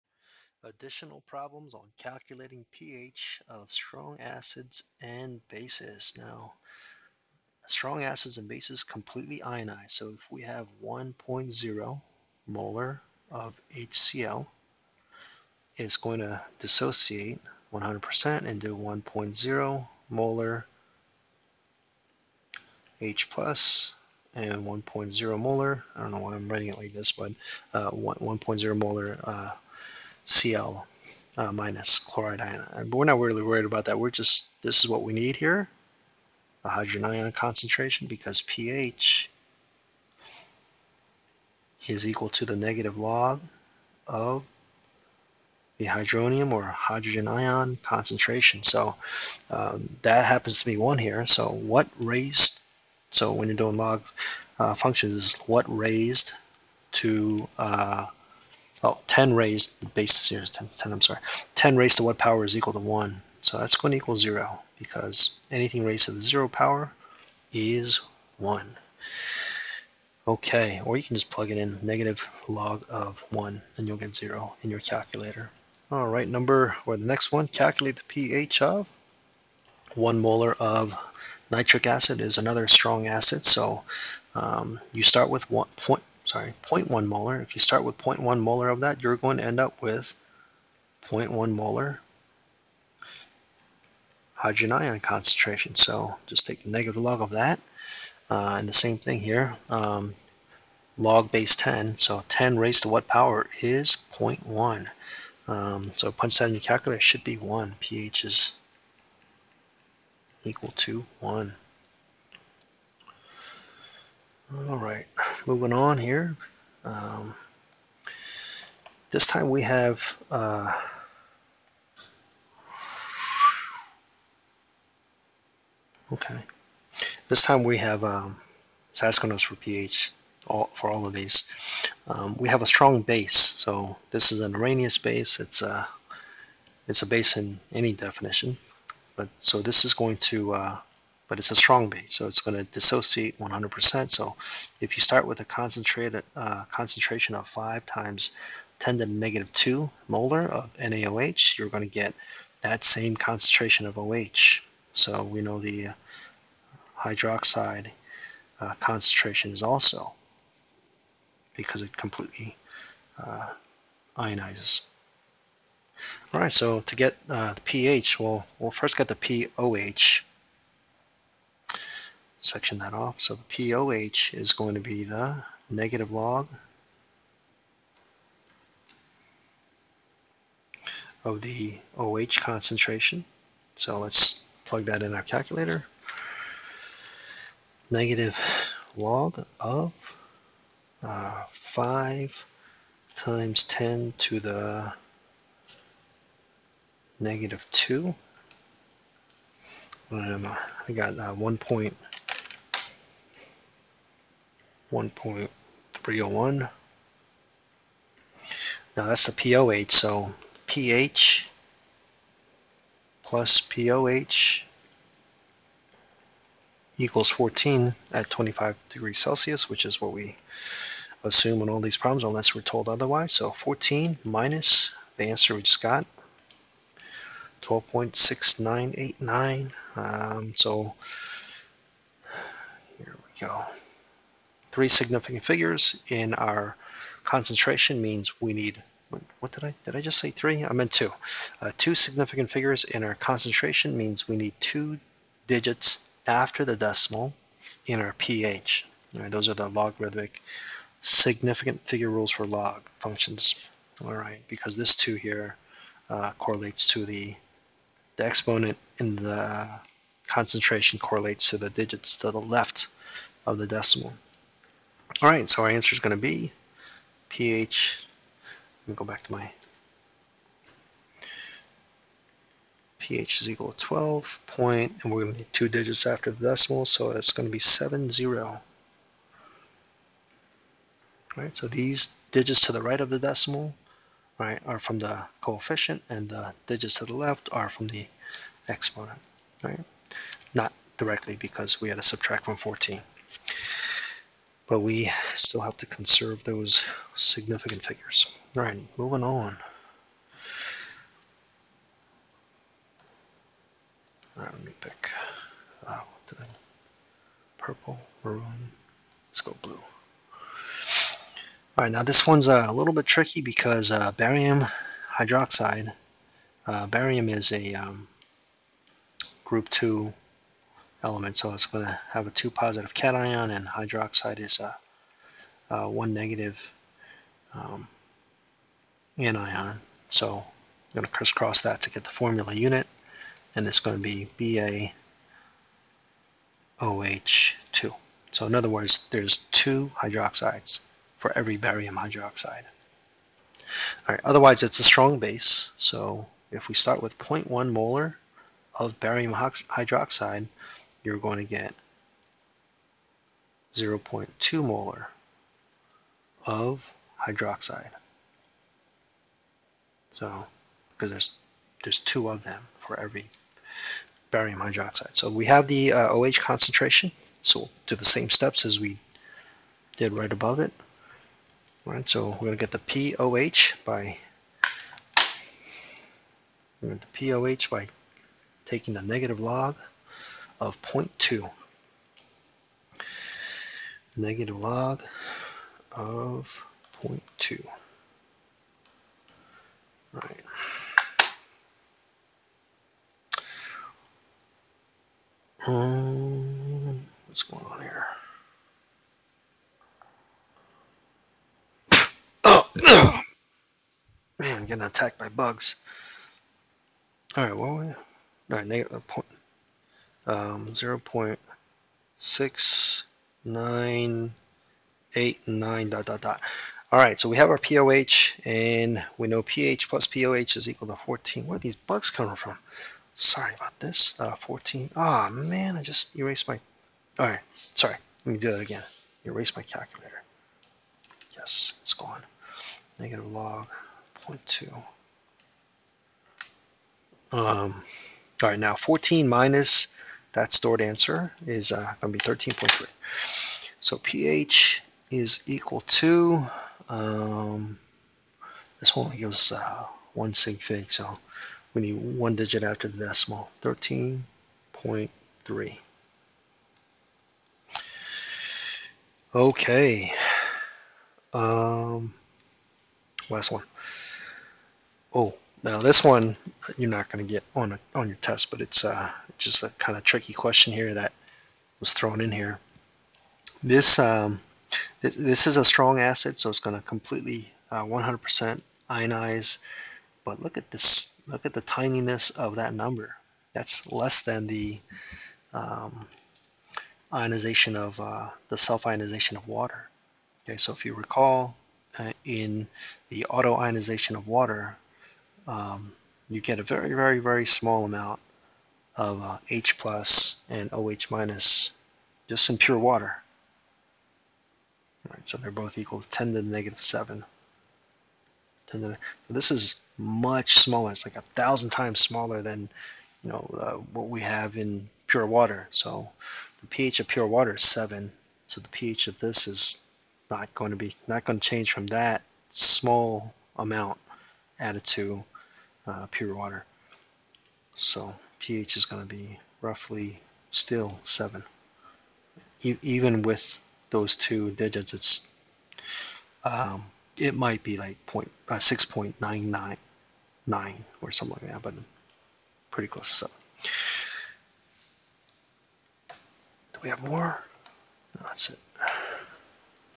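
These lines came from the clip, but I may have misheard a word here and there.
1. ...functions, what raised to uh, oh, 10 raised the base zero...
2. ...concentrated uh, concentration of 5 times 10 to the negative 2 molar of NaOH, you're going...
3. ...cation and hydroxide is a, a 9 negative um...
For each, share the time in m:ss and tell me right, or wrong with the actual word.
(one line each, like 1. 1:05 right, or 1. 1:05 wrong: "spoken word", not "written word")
1. 0:54 right
2. 2:25 right
3. 5:22 wrong: "1", not "9".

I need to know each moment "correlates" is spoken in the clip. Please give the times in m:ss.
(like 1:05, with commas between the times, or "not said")
4:16, 4:20.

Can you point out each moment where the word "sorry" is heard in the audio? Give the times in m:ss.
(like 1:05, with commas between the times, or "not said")
1:01, 1:26, 7:03, 7:07.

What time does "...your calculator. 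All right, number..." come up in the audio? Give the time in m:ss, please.
1:14.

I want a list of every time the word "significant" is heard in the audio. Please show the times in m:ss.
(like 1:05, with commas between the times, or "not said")
3:54, 4:01, 4:11, 4:57.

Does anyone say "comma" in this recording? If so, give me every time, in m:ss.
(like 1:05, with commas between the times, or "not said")
not said.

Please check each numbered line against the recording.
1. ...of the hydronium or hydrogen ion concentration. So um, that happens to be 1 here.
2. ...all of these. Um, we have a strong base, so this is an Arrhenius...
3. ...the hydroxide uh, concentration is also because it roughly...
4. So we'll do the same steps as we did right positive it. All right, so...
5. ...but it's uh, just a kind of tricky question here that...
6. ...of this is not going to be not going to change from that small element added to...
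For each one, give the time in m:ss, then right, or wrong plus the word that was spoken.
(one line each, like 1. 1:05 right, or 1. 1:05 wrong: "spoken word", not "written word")
1. 0:44 right
2. 2:10 right
3. 2:35 wrong: "completely", not "roughly"
4. 6:07 wrong: "above", not "positive"
5. 7:48 right
6. 8:39 wrong: "amount", not "element".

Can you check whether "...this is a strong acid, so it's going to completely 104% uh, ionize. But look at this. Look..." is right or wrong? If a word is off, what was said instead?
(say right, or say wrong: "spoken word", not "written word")
wrong: "100", not "104".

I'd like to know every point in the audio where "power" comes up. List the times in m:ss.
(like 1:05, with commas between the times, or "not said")
1:02, 1:06, 1:43.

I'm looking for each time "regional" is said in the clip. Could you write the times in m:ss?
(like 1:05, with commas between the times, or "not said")
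not said.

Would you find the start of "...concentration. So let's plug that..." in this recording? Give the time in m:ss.
3:02.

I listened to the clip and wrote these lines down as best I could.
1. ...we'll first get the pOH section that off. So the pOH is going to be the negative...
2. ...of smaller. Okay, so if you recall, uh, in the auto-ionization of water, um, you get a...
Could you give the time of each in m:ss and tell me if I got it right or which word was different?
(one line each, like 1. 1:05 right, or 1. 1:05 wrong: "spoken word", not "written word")
1. 2:48 right
2. 8:09 wrong: "water", not "smaller".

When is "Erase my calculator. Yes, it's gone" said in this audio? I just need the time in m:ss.
7:09.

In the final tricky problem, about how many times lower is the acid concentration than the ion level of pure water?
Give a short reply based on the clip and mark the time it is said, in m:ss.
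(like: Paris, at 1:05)
1000, at 8:31.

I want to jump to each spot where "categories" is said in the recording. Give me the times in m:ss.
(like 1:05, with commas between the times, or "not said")
not said.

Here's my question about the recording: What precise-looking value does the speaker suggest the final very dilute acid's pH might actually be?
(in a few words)
6.999.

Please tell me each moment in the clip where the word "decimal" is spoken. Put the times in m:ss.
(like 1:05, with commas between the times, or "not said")
4:06, 4:23, 4:36, 4:43, 7:33.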